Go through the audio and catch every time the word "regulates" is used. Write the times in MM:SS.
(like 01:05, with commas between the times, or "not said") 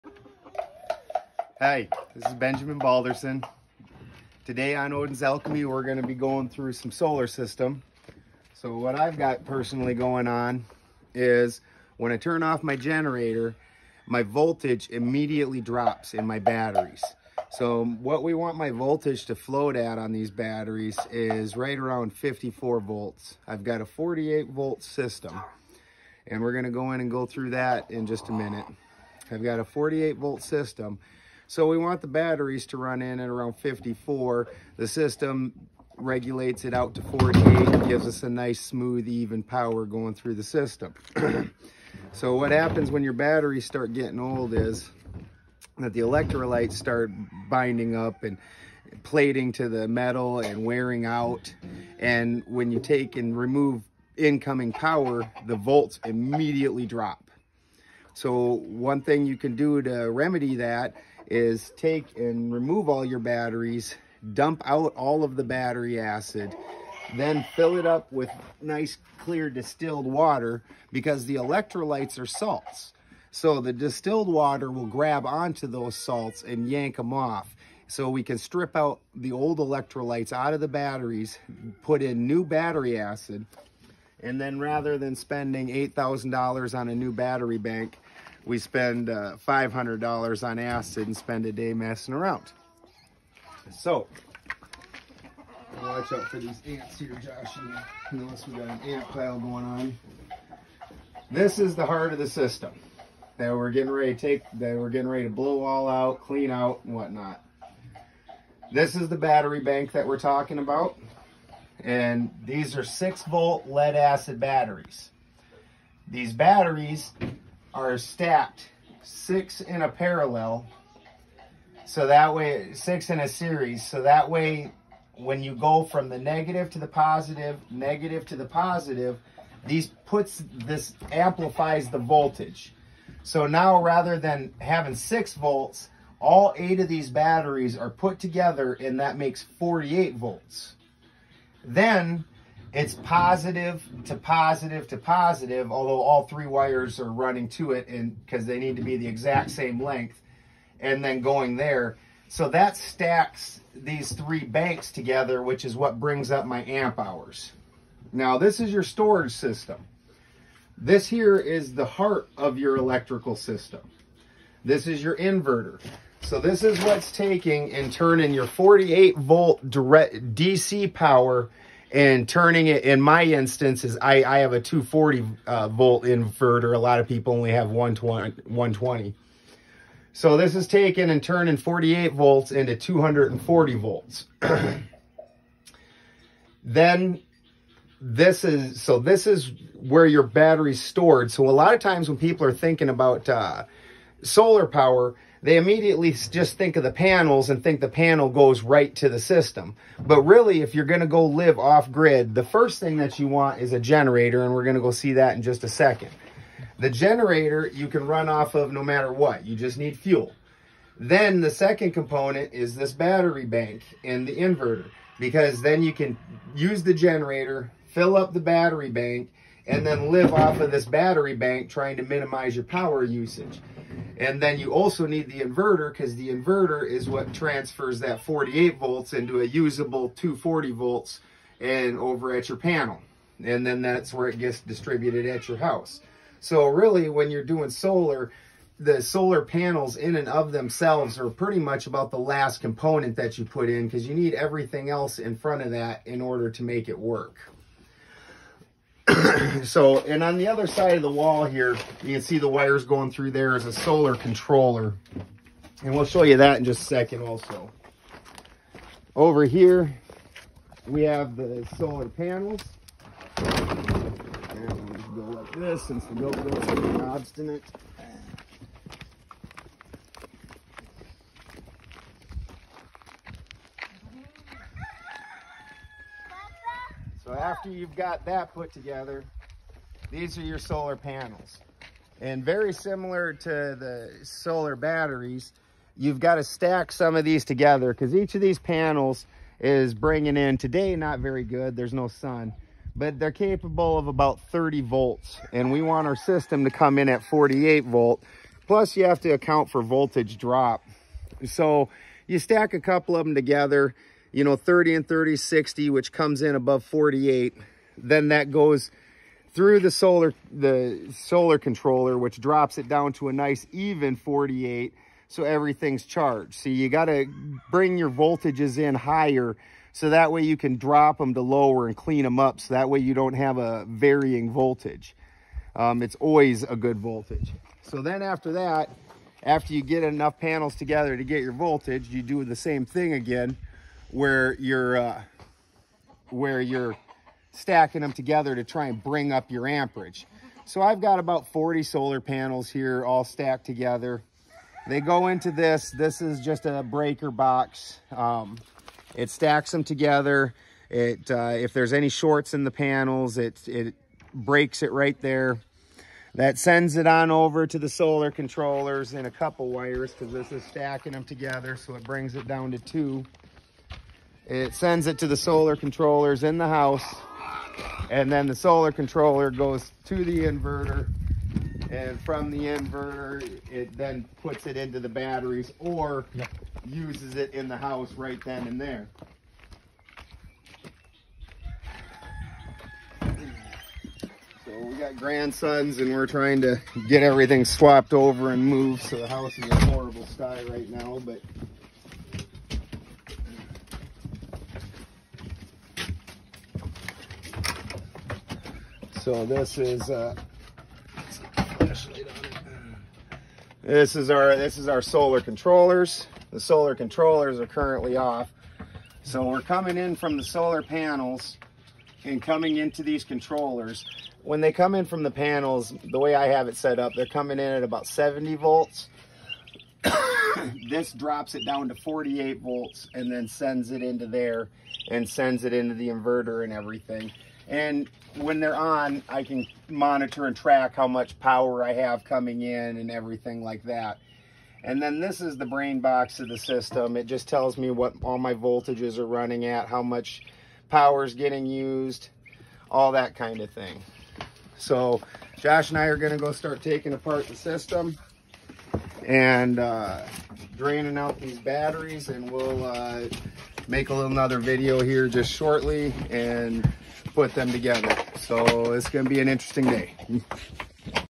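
00:35.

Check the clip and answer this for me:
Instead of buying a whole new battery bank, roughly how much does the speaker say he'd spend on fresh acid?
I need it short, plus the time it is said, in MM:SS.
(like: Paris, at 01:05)
$500, at 01:29.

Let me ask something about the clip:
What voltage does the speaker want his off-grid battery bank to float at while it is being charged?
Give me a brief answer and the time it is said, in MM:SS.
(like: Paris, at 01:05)
54 volts, at 00:22.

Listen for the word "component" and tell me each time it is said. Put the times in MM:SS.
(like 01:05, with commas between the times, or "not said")
03:31, 04:02.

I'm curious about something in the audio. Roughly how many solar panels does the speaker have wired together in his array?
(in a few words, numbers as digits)
40.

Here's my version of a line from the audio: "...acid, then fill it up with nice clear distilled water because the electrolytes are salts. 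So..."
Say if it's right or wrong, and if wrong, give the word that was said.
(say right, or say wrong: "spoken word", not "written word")
right.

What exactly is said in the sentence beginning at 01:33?
So, watch out for these ants here, Josh.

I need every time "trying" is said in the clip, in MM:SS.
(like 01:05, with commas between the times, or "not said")
03:41, 06:26.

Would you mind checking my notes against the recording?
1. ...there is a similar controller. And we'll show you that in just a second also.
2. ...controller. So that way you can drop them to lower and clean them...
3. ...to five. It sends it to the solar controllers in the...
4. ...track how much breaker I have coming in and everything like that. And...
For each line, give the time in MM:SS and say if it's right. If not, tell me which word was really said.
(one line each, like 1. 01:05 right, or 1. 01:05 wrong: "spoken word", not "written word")
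1. 04:13 wrong: "solar", not "similar"
2. 05:18 wrong: "higher", not "controller"
3. 06:02 wrong: "two", not "five"
4. 07:10 wrong: "power", not "breaker".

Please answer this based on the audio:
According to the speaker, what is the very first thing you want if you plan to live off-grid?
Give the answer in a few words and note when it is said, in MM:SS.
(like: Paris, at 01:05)
a generator, at 03:23.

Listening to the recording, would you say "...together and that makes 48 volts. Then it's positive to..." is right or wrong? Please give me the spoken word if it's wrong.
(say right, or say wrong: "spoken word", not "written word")
right.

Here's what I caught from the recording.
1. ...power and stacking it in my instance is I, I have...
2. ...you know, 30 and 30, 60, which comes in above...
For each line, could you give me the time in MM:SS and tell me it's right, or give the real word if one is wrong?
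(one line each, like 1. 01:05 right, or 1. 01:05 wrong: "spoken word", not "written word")
1. 02:50 wrong: "turning", not "stacking"
2. 05:04 right.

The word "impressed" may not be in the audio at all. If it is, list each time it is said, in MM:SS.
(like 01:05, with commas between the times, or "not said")
not said.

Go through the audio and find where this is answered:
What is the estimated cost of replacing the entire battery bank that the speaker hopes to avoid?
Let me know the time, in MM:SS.
01:25.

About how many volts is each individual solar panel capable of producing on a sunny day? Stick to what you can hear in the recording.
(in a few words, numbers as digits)
30 volts.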